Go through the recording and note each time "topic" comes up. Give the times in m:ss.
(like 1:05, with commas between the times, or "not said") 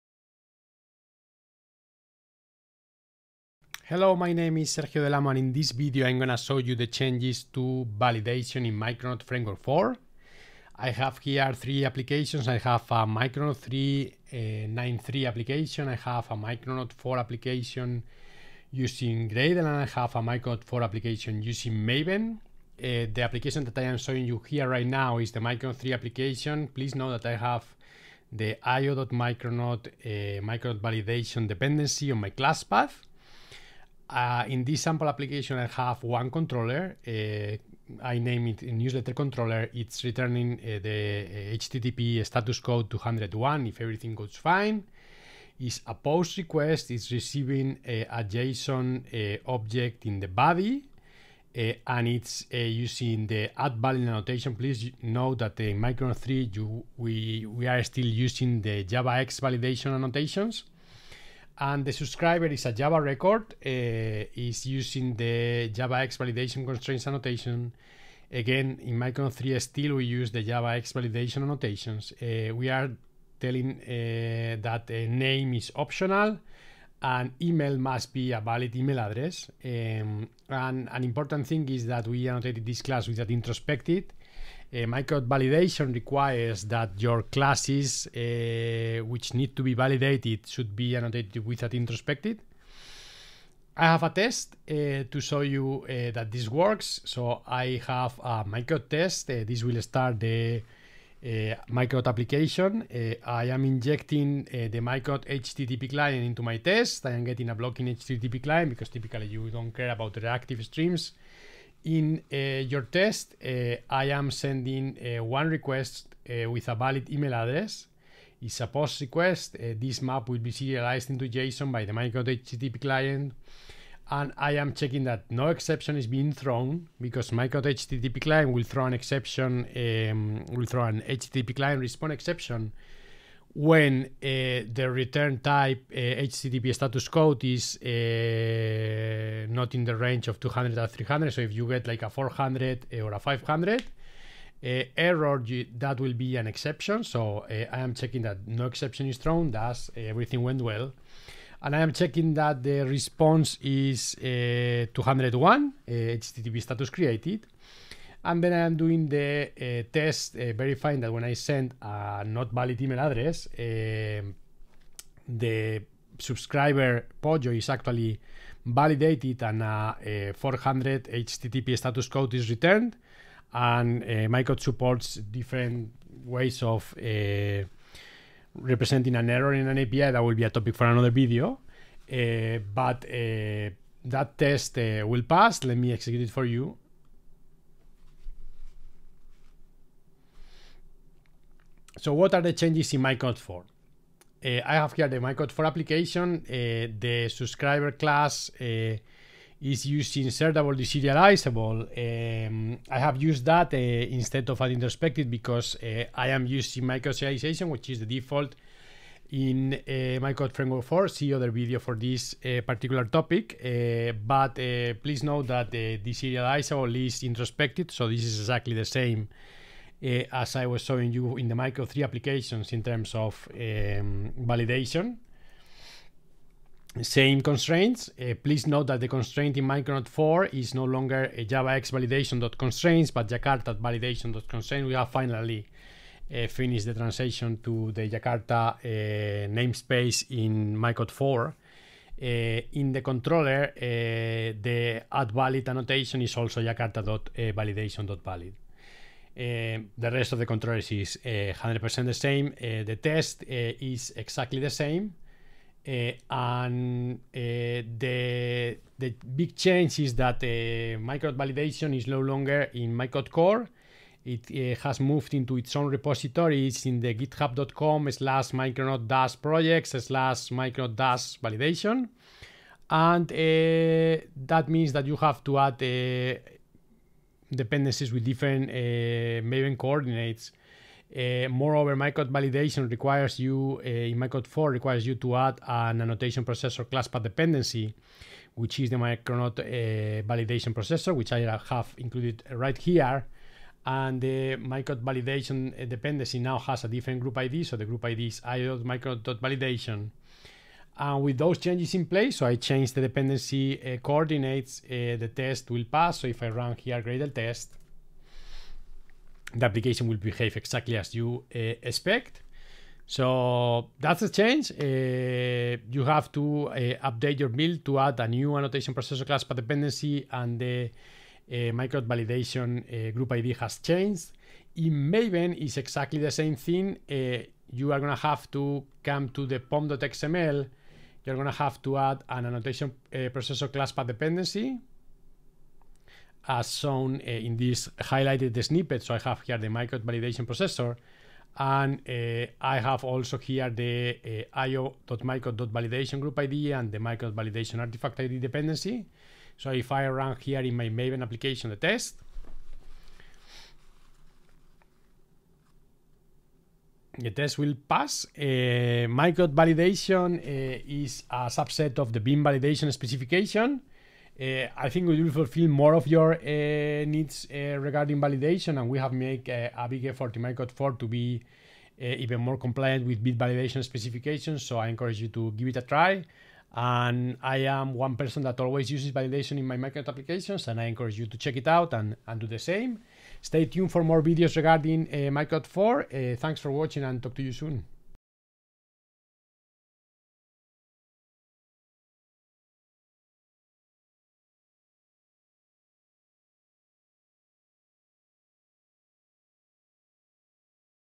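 3:00, 3:33.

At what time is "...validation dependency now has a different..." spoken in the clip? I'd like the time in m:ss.
4:55.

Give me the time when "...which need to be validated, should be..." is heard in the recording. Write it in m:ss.
1:29.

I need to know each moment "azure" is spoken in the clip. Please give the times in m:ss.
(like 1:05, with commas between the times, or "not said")
not said.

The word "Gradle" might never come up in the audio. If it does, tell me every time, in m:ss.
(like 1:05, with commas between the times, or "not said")
0:19, 5:07.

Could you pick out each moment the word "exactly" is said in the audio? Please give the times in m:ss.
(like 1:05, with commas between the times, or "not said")
3:38, 4:14, 5:10, 5:25.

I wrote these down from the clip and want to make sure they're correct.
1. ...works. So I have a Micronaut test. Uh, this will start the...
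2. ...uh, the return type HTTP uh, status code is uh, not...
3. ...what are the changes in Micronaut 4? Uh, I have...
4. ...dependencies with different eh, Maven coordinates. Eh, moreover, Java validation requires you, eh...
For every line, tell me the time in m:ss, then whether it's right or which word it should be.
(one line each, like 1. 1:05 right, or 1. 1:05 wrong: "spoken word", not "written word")
1. 1:36 right
2. 2:14 right
3. 3:12 right
4. 4:37 wrong: "Micronaut", not "Java".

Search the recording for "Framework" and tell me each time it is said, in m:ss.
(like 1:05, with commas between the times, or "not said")
0:09, 3:30.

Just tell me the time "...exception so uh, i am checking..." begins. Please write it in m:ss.
2:26.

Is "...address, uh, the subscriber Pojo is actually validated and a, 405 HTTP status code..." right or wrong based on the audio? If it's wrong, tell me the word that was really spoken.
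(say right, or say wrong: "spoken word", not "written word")
wrong: "400", not "405".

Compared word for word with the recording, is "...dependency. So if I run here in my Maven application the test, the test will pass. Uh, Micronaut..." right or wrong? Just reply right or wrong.
right.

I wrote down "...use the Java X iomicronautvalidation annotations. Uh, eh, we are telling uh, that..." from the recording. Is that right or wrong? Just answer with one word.
wrong.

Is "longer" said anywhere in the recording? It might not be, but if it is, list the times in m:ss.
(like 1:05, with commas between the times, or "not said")
3:50, 4:22.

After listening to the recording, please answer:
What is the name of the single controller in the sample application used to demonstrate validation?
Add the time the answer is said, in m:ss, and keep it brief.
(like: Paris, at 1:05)
Newsletter controller, at 0:38.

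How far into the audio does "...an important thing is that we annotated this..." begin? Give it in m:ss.
1:20.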